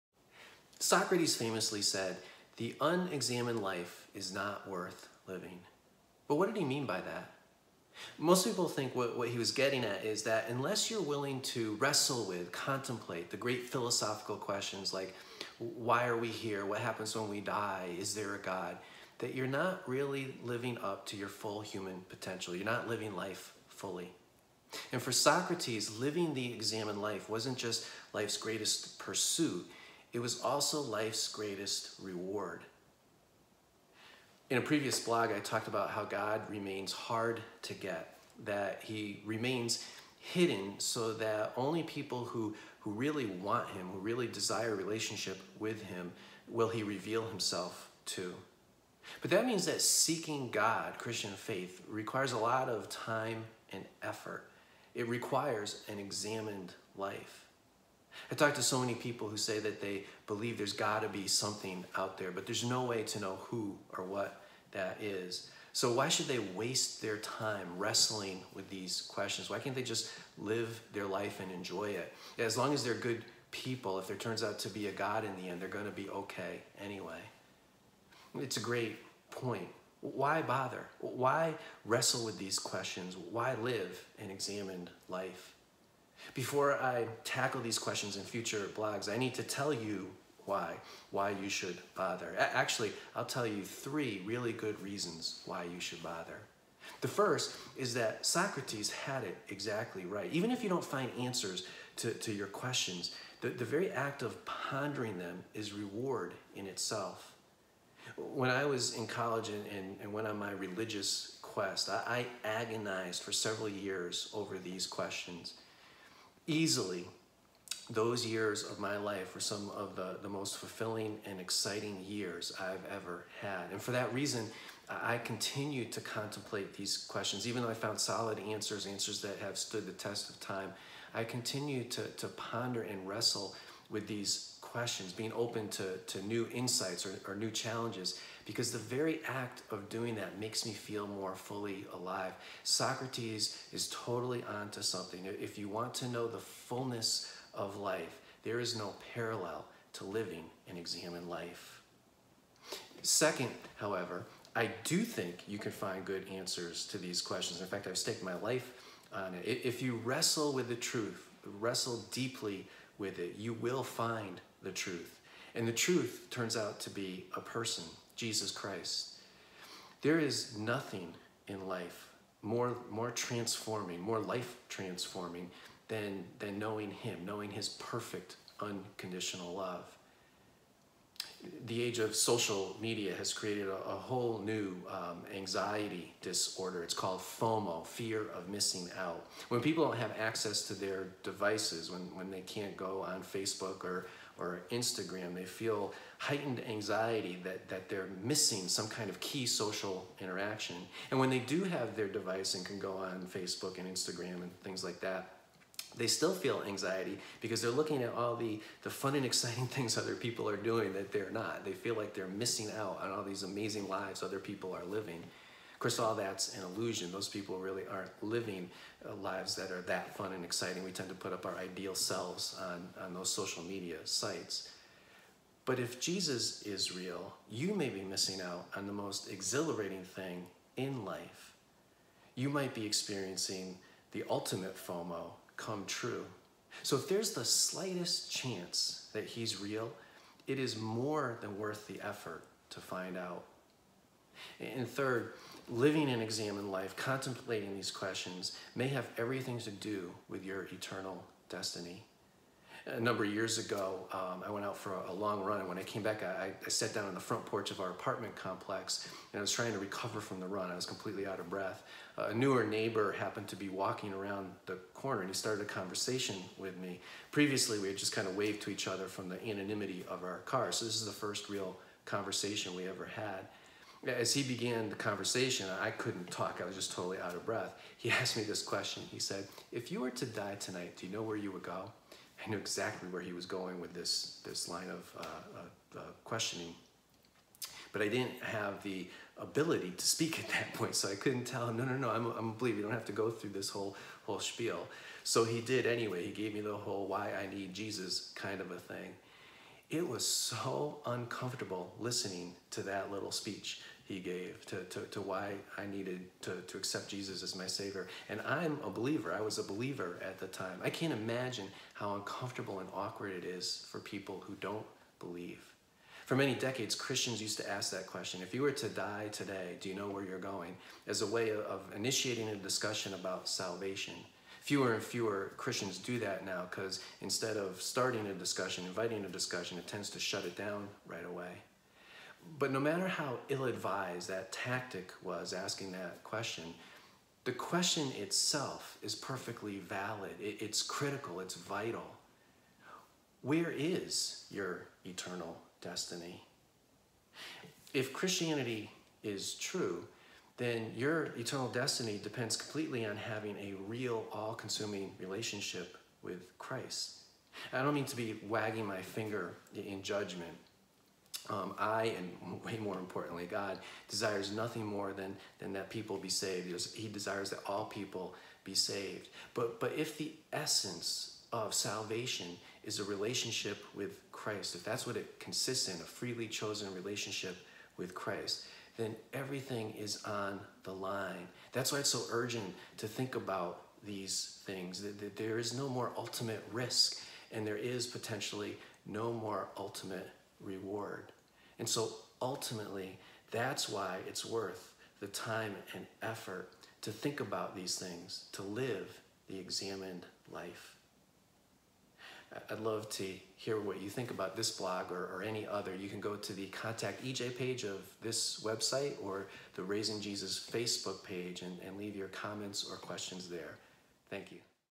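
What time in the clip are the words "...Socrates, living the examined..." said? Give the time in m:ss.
0:25.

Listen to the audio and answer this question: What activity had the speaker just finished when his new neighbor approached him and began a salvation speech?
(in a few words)
a long run.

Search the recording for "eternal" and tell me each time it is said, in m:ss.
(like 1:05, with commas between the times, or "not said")
4:10, 5:45, 5:51.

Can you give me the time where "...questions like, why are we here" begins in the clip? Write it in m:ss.
0:14.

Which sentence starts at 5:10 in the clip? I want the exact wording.
I can't imagine how uncomfortable and awkward it is for people who don't believe.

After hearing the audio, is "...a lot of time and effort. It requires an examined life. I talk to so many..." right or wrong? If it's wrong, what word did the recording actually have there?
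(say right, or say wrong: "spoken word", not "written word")
right.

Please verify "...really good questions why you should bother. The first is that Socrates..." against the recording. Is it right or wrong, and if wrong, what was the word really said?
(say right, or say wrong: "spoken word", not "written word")
wrong: "reasons", not "questions".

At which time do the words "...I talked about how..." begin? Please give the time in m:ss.
0:35.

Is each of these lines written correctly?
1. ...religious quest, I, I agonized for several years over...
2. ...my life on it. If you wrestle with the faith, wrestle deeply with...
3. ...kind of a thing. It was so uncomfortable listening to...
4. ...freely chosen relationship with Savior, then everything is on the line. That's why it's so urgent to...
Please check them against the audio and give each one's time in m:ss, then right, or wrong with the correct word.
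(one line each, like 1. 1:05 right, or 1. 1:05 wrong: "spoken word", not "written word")
1. 1:50 right
2. 2:38 wrong: "truth", not "faith"
3. 4:58 right
4. 6:16 wrong: "Christ", not "Savior".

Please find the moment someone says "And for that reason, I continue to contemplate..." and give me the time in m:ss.
2:03.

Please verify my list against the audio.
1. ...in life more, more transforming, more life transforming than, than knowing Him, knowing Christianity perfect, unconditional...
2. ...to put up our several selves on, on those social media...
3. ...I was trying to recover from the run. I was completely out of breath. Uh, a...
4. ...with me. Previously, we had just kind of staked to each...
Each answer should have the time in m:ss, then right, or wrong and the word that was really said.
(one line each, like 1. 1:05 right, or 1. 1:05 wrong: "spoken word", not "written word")
1. 2:51 wrong: "His", not "Christianity"
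2. 3:41 wrong: "ideal", not "several"
3. 4:19 right
4. 4:26 wrong: "waved", not "staked".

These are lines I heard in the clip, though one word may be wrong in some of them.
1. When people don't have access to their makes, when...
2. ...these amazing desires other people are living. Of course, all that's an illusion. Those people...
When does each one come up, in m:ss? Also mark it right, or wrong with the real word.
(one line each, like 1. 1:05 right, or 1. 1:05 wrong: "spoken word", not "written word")
1. 3:09 wrong: "devices", not "makes"
2. 3:33 wrong: "lives", not "desires".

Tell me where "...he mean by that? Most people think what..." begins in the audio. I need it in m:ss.
0:06.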